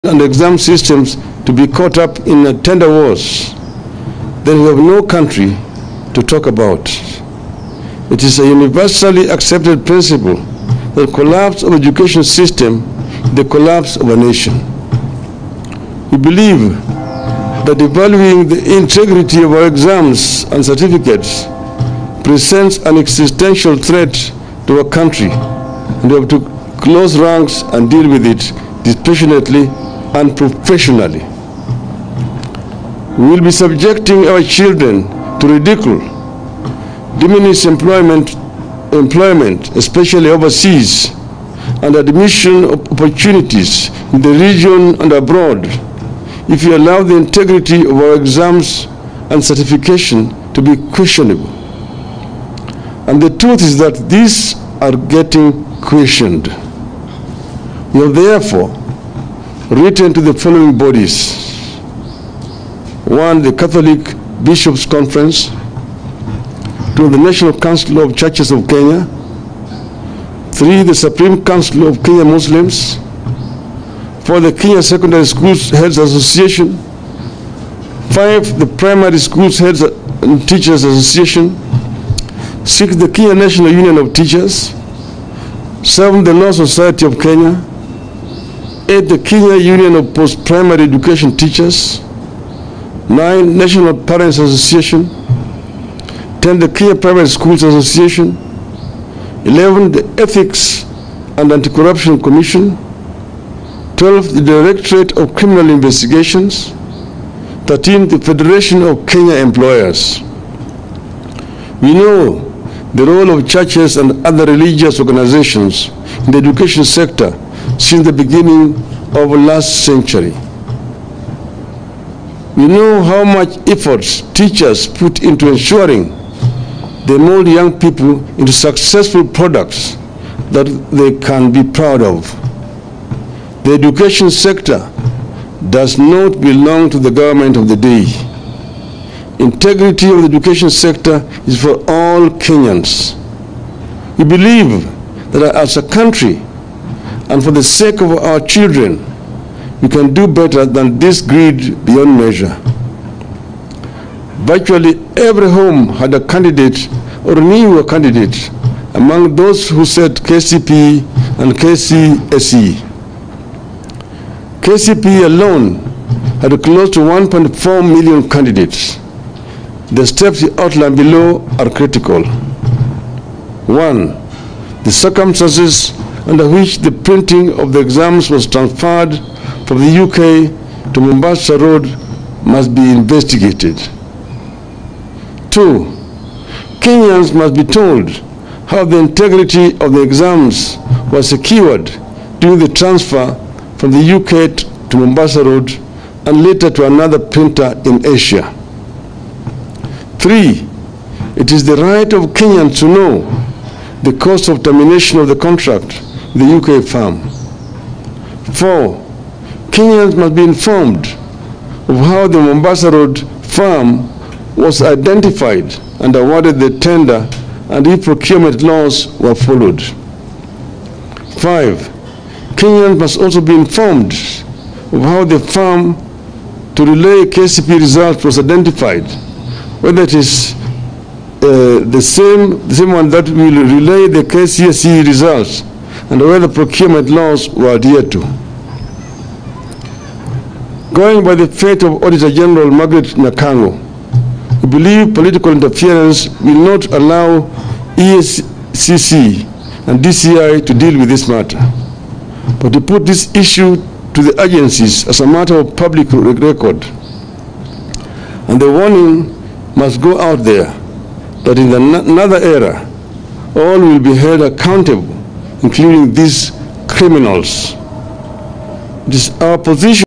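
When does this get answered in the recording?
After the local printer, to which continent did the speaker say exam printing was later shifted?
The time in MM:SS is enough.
03:18.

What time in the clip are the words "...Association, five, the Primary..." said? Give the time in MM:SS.
01:15.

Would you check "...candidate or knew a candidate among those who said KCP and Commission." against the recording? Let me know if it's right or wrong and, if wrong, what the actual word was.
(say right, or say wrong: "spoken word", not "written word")
wrong: "KCSE", not "Commission".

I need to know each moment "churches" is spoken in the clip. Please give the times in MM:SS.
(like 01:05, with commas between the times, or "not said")
01:08, 01:53.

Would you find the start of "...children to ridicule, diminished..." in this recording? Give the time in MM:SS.
00:34.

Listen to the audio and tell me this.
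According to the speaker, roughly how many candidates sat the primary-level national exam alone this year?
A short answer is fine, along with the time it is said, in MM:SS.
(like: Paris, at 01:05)
1.4 million, at 02:46.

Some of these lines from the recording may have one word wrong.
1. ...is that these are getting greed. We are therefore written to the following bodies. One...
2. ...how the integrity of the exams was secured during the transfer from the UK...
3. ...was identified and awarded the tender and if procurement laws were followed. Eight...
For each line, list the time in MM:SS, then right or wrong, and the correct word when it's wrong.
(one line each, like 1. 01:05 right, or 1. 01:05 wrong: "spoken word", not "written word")
1. 00:53 wrong: "questioned", not "greed"
2. 03:08 right
3. 03:34 wrong: "Five", not "Eight".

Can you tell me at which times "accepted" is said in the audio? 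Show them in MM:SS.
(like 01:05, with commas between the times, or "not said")
00:09.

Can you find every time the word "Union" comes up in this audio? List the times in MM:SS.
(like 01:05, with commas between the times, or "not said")
01:23, 01:29.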